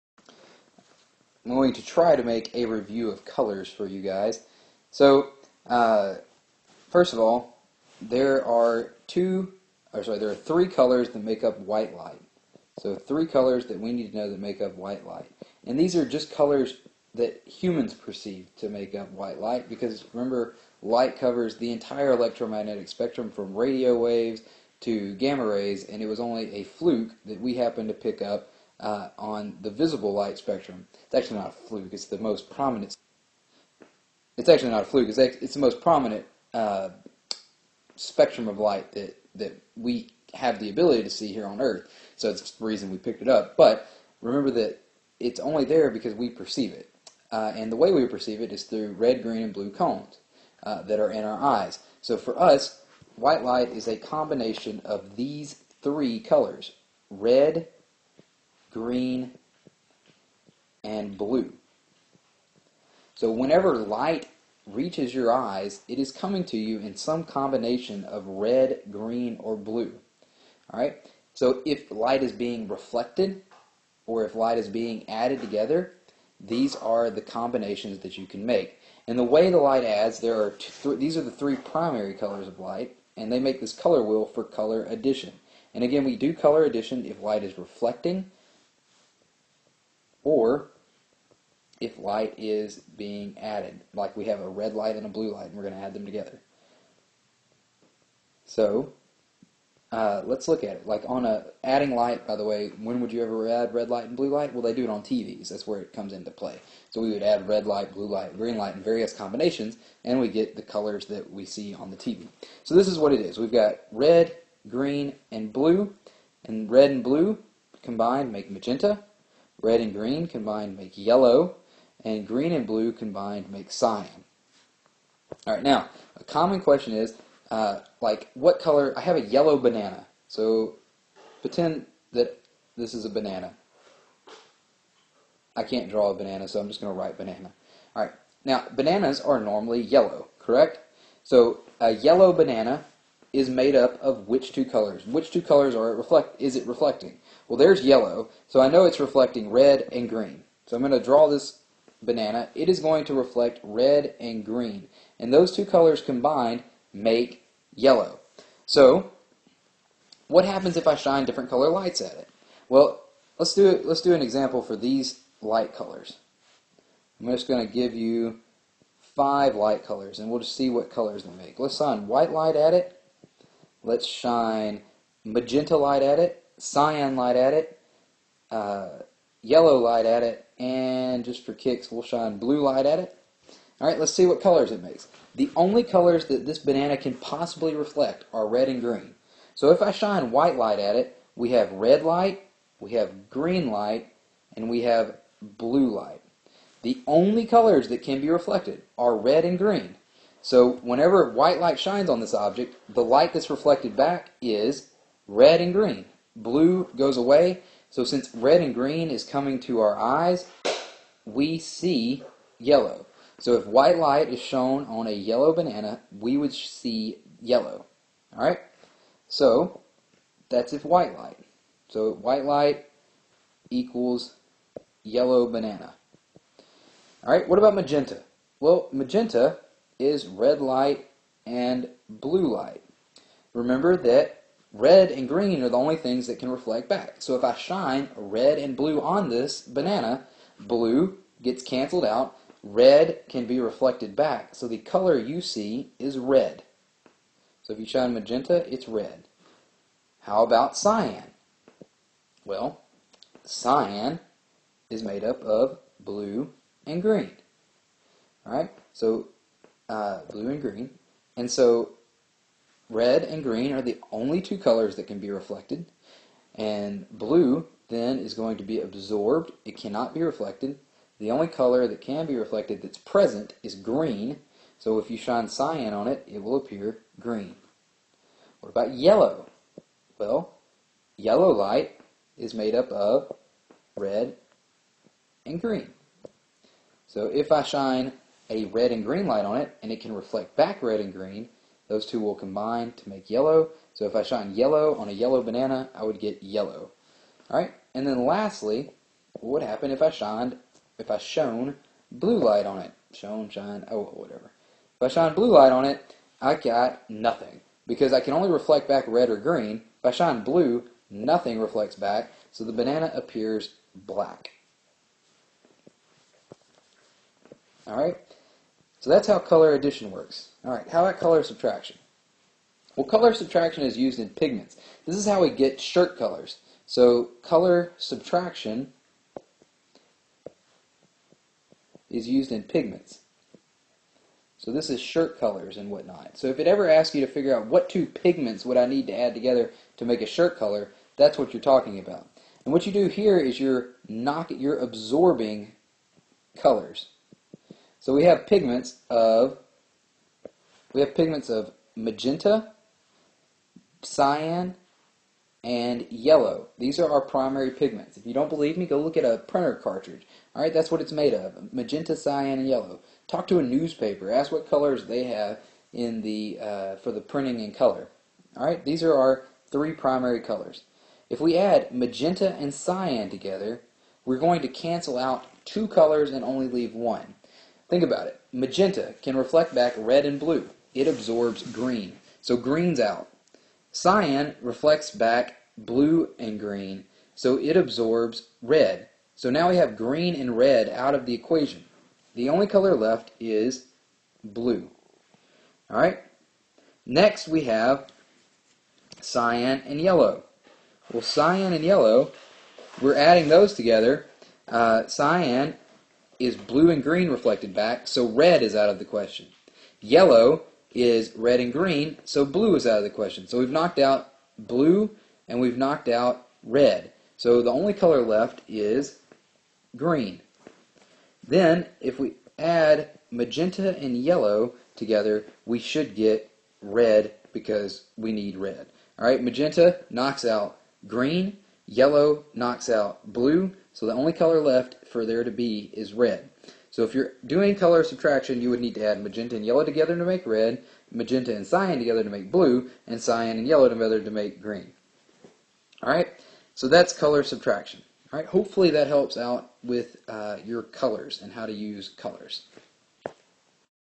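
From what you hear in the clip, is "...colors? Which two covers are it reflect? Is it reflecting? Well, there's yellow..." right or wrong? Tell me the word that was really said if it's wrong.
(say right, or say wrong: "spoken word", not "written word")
wrong: "colors", not "covers".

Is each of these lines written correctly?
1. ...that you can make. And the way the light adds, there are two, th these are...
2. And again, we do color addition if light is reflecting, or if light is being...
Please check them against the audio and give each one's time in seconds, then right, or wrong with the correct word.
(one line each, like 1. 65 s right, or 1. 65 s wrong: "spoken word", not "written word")
1. 77 s right
2. 85 s right.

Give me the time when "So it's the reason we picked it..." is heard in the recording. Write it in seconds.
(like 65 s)
42 s.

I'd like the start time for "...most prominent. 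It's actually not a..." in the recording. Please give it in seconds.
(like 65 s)
32 s.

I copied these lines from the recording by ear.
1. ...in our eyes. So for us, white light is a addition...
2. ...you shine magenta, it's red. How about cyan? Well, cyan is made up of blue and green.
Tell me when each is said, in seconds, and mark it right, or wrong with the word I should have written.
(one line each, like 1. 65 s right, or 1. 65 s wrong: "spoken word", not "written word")
1. 51 s wrong: "combination", not "addition"
2. 247 s right.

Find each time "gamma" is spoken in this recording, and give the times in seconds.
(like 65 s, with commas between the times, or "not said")
25 s.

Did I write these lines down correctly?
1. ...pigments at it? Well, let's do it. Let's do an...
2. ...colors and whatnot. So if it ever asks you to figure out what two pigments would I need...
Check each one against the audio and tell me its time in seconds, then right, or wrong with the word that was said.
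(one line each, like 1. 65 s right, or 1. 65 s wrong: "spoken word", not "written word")
1. 161 s wrong: "lights", not "pigments"
2. 335 s right.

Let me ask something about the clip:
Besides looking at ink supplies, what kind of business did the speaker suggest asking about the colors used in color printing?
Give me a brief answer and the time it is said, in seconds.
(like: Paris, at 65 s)
A newspaper, at 363 s.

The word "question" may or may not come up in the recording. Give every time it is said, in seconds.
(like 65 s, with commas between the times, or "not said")
126 s, 409 s, 413 s.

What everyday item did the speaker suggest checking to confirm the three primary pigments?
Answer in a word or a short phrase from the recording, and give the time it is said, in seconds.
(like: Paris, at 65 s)
A printer cartridge, at 359 s.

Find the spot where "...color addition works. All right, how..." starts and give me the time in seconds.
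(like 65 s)
319 s.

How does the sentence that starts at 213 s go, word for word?
So if white light is shown on a yellow banana, we would see yellow.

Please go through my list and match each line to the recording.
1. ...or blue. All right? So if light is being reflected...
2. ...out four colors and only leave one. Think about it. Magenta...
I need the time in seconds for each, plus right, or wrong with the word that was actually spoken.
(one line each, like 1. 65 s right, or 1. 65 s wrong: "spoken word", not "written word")
1. 69 s right
2. 375 s wrong: "two", not "four".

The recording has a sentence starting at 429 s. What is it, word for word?
All right, magenta knocks out green, Yellow knocks out blue, so the only color left for there to be is red.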